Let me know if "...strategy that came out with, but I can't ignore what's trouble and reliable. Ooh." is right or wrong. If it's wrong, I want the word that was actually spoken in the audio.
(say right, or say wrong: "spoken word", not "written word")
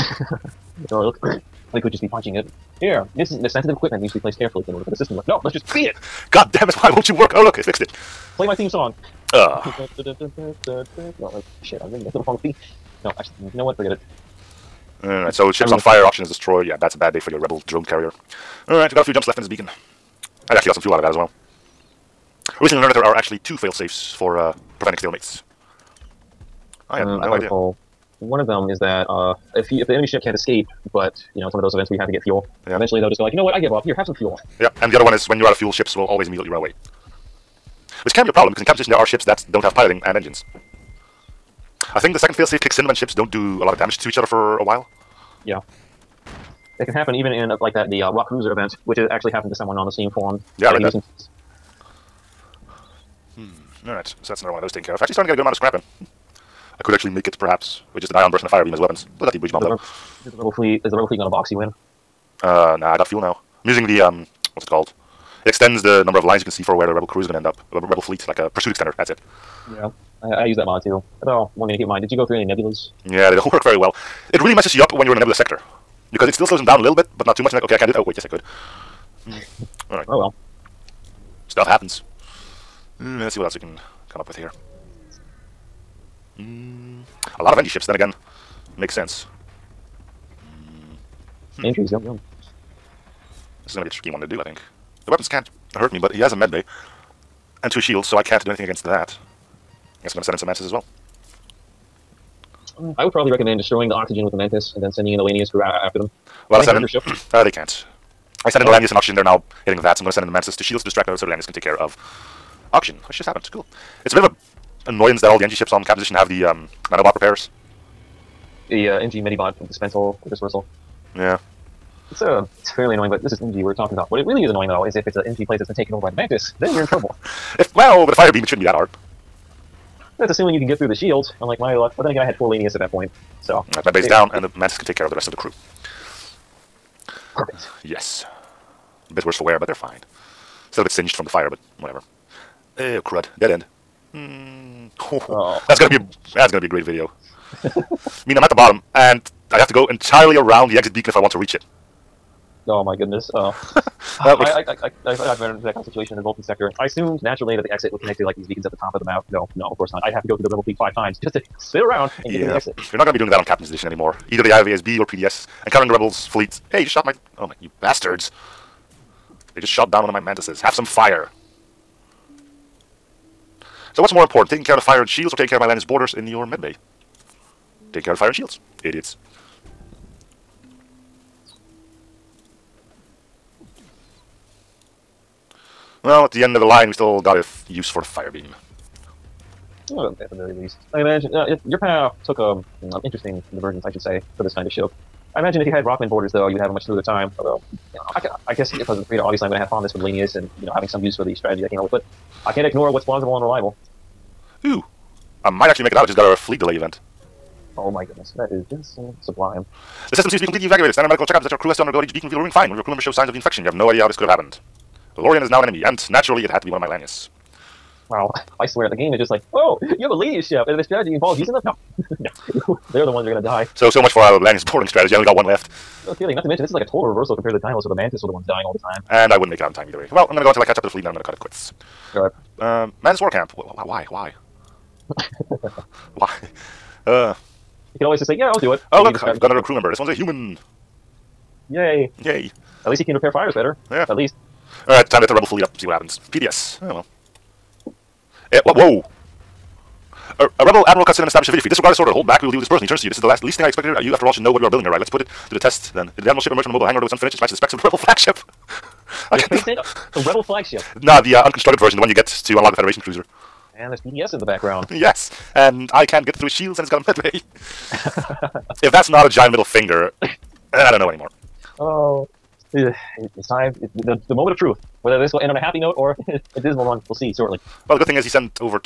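wrong: "plausible", not "trouble".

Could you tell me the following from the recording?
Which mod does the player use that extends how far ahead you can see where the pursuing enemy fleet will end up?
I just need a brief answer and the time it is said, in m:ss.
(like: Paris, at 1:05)
Pursuit extender, at 1:08.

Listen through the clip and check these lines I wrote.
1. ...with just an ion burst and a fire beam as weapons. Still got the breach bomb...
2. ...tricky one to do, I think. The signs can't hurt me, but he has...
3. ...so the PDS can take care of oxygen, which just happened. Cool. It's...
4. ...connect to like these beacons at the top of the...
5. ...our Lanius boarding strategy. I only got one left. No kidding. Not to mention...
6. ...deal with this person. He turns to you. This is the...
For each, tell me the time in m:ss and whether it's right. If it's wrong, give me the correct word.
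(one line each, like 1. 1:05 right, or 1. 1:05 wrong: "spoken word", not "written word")
1. 0:57 right
2. 1:33 wrong: "weapons", not "signs"
3. 1:51 wrong: "Lanius", not "PDS"
4. 2:38 right
5. 3:44 right
6. 4:12 right.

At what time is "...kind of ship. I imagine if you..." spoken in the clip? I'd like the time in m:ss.
3:14.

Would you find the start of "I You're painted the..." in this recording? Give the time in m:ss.
4:19.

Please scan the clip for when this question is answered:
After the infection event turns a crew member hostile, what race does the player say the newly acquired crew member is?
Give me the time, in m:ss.
4:00.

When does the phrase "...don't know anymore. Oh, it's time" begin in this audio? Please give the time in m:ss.
4:30.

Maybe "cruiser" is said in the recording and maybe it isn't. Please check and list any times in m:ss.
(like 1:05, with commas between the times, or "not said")
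0:48, 4:23.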